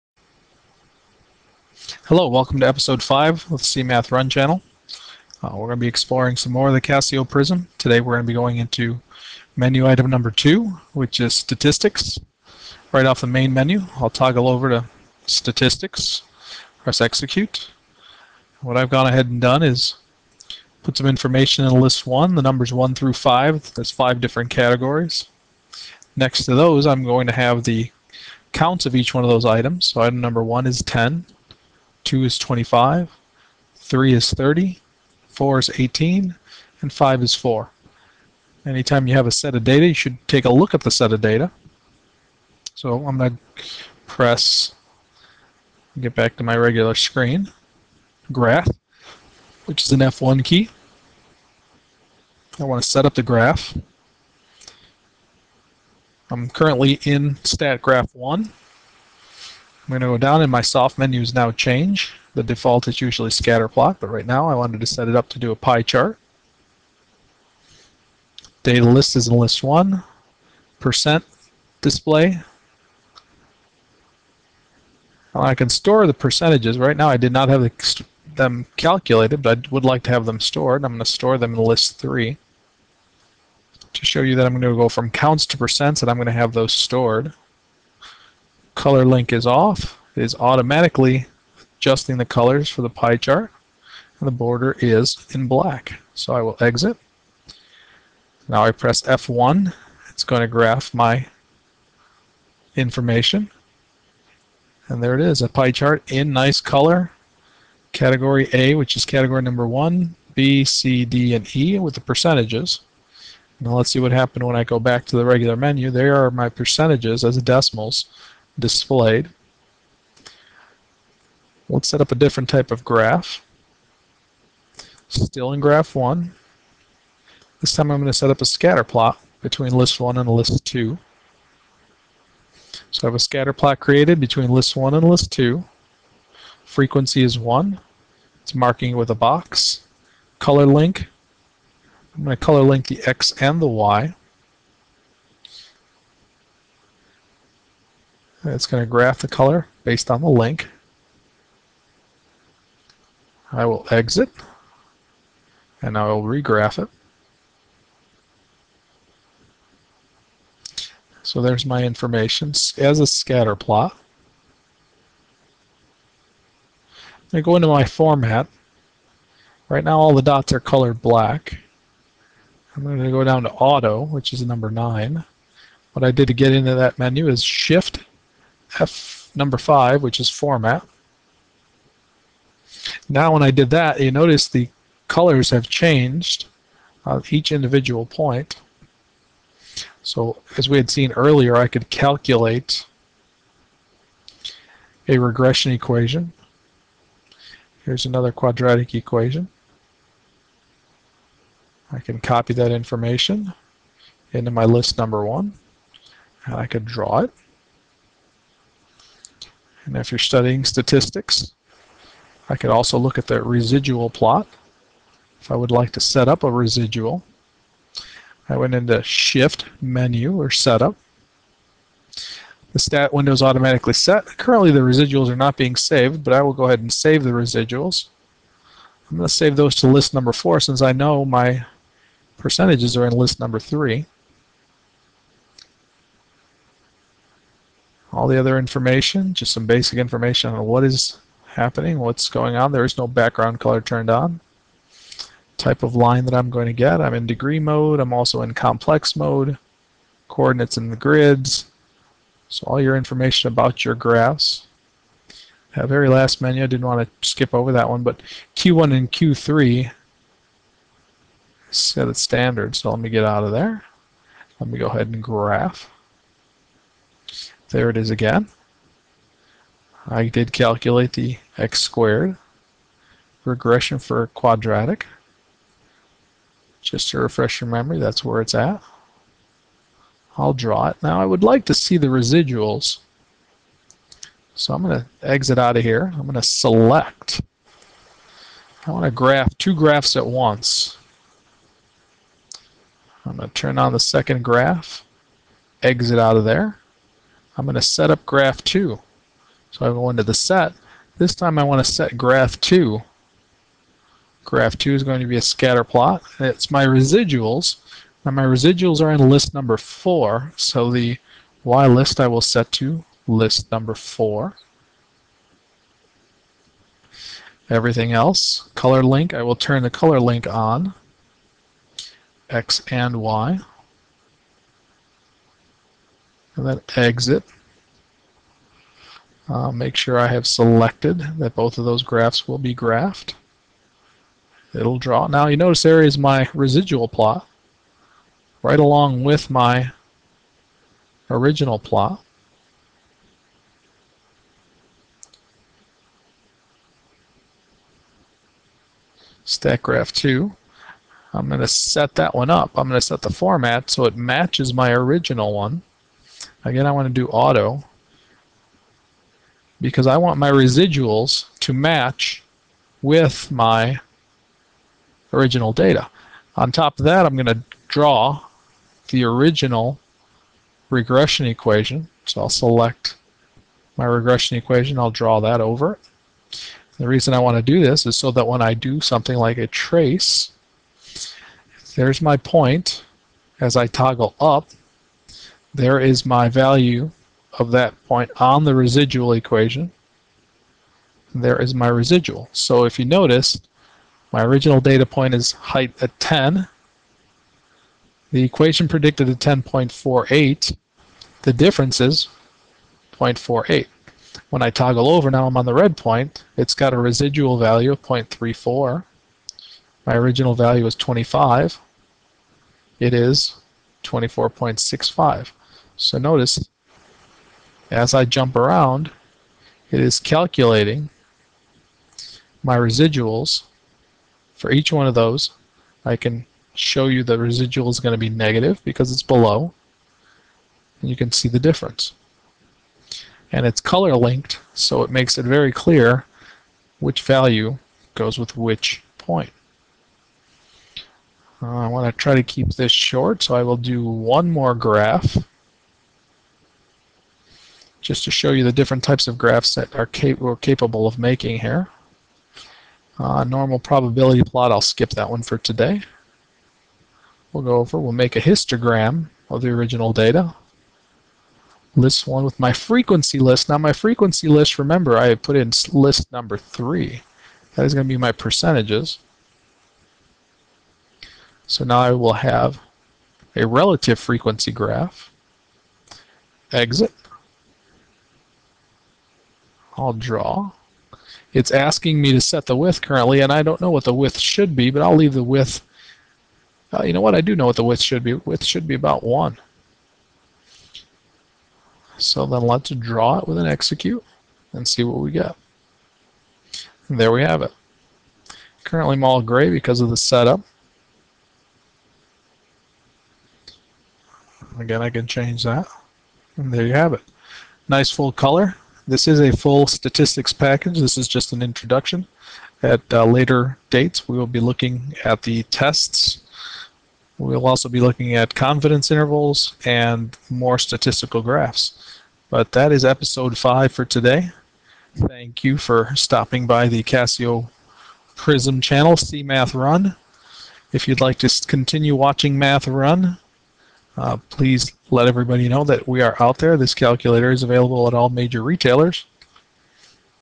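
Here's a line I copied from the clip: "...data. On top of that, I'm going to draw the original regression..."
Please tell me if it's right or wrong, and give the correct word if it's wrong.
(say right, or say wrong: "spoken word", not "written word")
right.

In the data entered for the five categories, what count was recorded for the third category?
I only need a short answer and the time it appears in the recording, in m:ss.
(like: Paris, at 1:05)
30, at 0:34.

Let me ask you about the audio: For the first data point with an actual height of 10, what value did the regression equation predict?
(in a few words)
10.48.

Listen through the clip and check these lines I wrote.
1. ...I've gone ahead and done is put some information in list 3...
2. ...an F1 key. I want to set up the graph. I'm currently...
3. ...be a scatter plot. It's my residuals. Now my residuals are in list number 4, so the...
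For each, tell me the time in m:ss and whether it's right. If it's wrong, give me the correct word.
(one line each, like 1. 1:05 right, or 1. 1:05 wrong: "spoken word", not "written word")
1. 0:18 wrong: "1", not "3"
2. 0:49 right
3. 5:05 right.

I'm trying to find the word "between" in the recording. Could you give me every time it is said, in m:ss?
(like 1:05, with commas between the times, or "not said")
2:09, 2:14.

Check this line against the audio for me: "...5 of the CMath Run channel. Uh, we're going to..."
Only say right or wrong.
right.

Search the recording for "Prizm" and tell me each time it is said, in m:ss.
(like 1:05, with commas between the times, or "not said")
0:07, 8:48.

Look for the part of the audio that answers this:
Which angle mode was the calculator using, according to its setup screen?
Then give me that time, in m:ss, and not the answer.
4:07.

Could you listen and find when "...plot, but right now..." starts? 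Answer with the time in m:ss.
1:03.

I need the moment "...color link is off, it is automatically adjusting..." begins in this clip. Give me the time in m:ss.
1:28.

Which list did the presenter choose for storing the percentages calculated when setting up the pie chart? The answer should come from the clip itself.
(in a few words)
List 3.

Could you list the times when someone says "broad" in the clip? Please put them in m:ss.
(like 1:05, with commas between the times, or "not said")
not said.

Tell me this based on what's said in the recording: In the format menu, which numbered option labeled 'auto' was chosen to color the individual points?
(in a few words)
9.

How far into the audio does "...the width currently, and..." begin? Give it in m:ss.
8:02.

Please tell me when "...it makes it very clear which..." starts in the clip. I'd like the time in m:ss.
7:15.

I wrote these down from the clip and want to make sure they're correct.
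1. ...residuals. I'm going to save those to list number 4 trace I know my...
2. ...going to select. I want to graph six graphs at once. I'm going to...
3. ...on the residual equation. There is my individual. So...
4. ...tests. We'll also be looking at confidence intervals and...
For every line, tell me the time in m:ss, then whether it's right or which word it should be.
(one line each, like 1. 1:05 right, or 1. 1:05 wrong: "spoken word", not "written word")
1. 3:47 wrong: "since", not "trace"
2. 4:46 wrong: "two", not "six"
3. 6:28 wrong: "residual", not "individual"
4. 8:35 right.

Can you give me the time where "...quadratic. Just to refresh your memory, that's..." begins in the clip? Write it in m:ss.
4:34.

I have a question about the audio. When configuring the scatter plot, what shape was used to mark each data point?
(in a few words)
A box.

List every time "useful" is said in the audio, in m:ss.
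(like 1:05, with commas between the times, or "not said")
not said.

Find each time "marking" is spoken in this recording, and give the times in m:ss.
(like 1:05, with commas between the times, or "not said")
2:18.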